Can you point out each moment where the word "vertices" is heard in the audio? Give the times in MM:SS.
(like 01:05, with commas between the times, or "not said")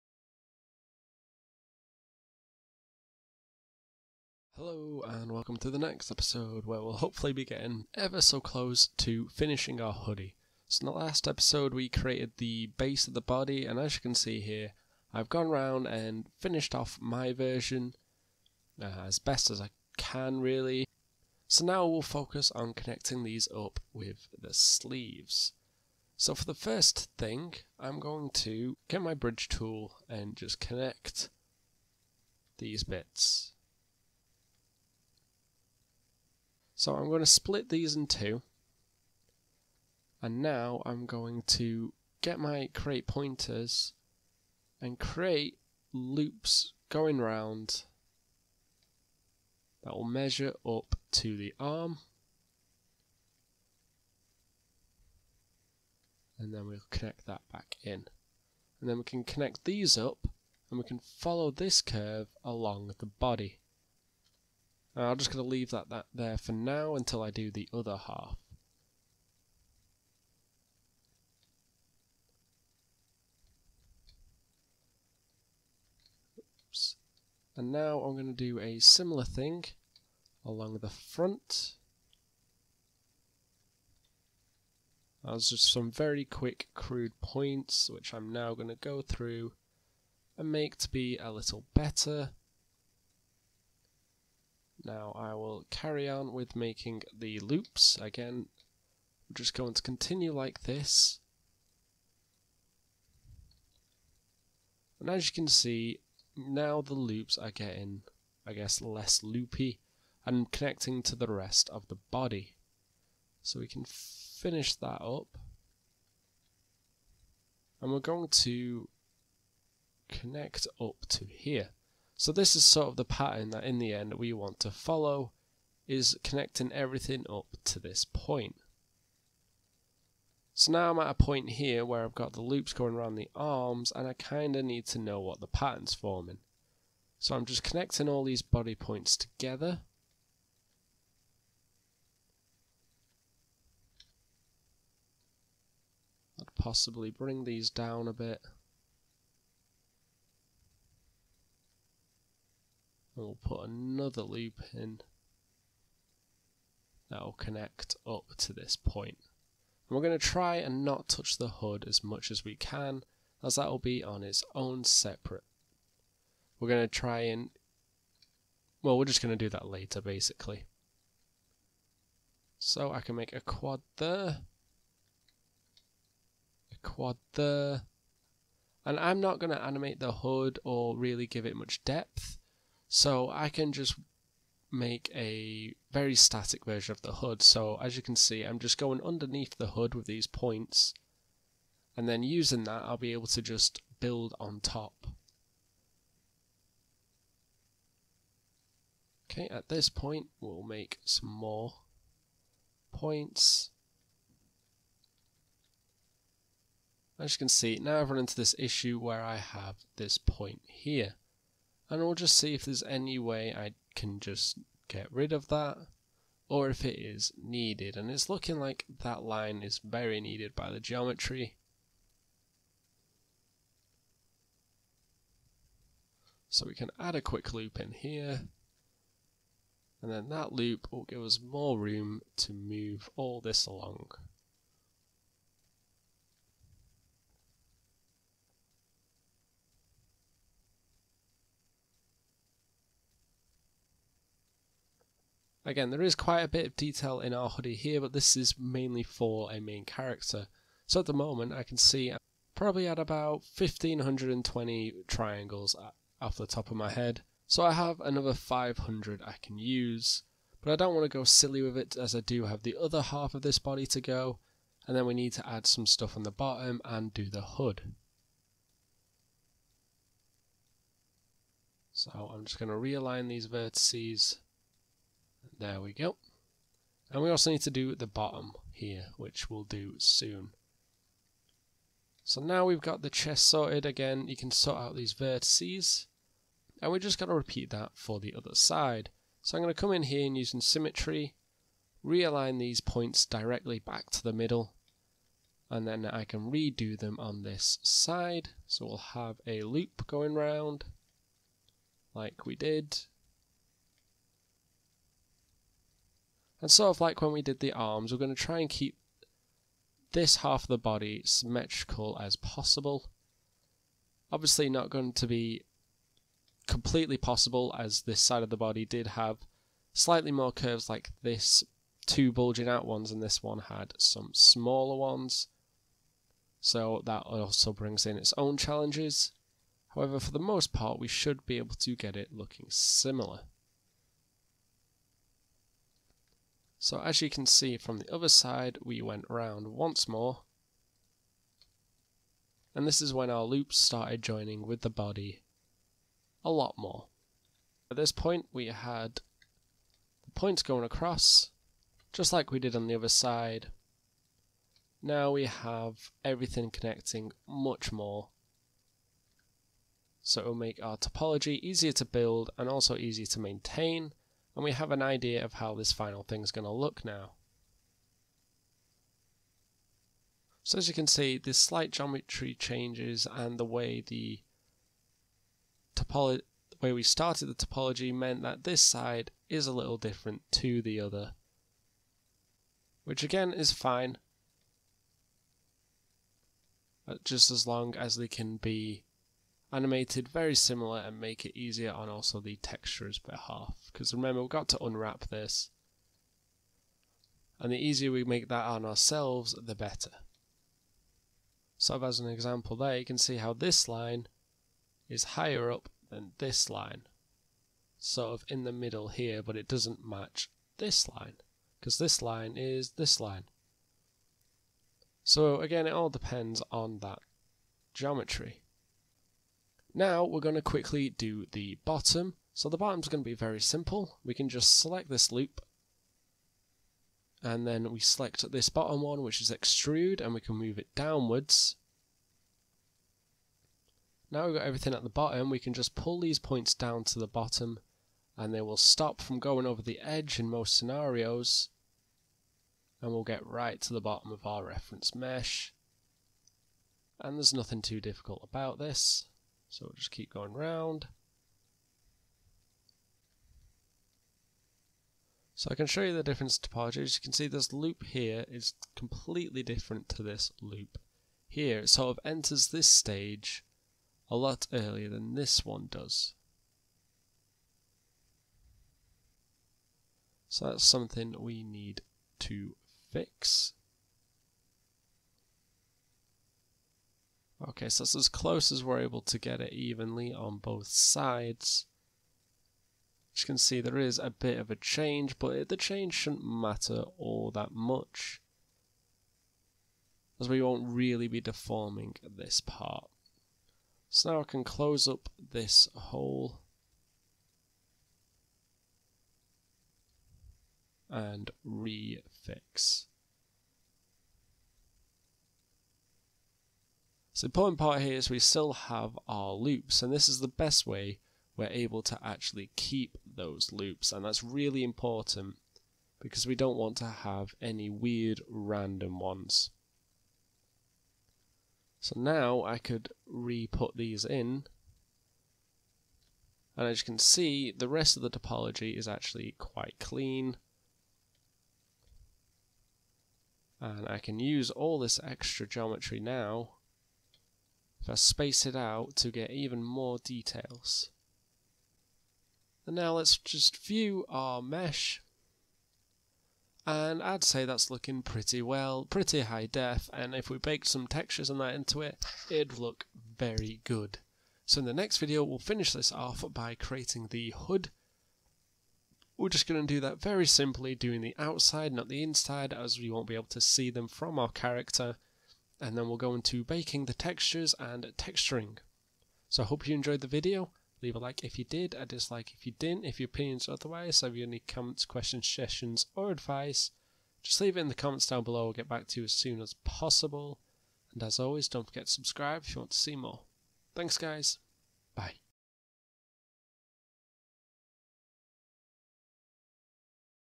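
04:33, 04:45.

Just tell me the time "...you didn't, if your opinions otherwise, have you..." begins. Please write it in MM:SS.
09:32.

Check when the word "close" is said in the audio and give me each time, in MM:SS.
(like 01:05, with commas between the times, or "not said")
00:08, 07:58, 08:14.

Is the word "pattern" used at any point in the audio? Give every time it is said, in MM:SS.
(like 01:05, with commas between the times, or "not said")
02:03, 02:15.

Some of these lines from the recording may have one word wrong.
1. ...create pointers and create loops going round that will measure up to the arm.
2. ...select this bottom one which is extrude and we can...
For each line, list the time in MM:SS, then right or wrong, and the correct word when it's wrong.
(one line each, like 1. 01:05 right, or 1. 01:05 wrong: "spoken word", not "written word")
1. 00:42 right
2. 07:07 right.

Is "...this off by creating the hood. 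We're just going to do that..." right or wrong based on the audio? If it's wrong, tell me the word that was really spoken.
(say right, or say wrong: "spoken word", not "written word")
right.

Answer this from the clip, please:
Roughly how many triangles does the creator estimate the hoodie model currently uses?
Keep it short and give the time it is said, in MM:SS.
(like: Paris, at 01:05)
1520, at 04:13.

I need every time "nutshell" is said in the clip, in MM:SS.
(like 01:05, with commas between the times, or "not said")
not said.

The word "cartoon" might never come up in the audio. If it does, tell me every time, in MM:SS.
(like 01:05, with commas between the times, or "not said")
not said.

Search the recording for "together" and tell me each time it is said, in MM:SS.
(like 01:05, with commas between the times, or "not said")
02:19.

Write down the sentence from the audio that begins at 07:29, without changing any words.
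So we'll just keep going round.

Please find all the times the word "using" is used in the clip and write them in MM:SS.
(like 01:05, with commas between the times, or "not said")
03:12, 04:50.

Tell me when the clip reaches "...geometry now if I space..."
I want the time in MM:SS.
08:55.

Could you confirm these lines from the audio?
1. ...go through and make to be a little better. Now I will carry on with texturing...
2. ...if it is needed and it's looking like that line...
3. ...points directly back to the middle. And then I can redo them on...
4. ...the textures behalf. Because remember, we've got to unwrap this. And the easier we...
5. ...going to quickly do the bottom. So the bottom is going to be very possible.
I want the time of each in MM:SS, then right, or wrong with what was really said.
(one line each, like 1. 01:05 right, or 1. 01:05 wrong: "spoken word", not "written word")
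1. 01:28 wrong: "making", not "texturing"
2. 03:36 right
3. 04:52 right
4. 06:32 right
5. 07:00 wrong: "simple", not "possible".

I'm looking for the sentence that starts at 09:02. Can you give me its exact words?
And now let's just view our mesh.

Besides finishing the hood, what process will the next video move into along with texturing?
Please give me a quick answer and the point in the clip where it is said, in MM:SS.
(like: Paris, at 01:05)
baking the textures, at 09:26.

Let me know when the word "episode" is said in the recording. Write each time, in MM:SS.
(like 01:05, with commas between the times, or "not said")
00:06, 00:11.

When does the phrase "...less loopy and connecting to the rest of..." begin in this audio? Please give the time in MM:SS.
01:48.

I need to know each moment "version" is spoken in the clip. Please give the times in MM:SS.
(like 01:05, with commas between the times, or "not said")
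00:17, 03:06.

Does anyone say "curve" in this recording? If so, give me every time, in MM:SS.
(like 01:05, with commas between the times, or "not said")
01:01, 05:20.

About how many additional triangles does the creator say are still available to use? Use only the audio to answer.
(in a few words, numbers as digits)
500.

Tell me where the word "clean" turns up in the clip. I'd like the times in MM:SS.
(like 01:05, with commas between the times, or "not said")
08:49.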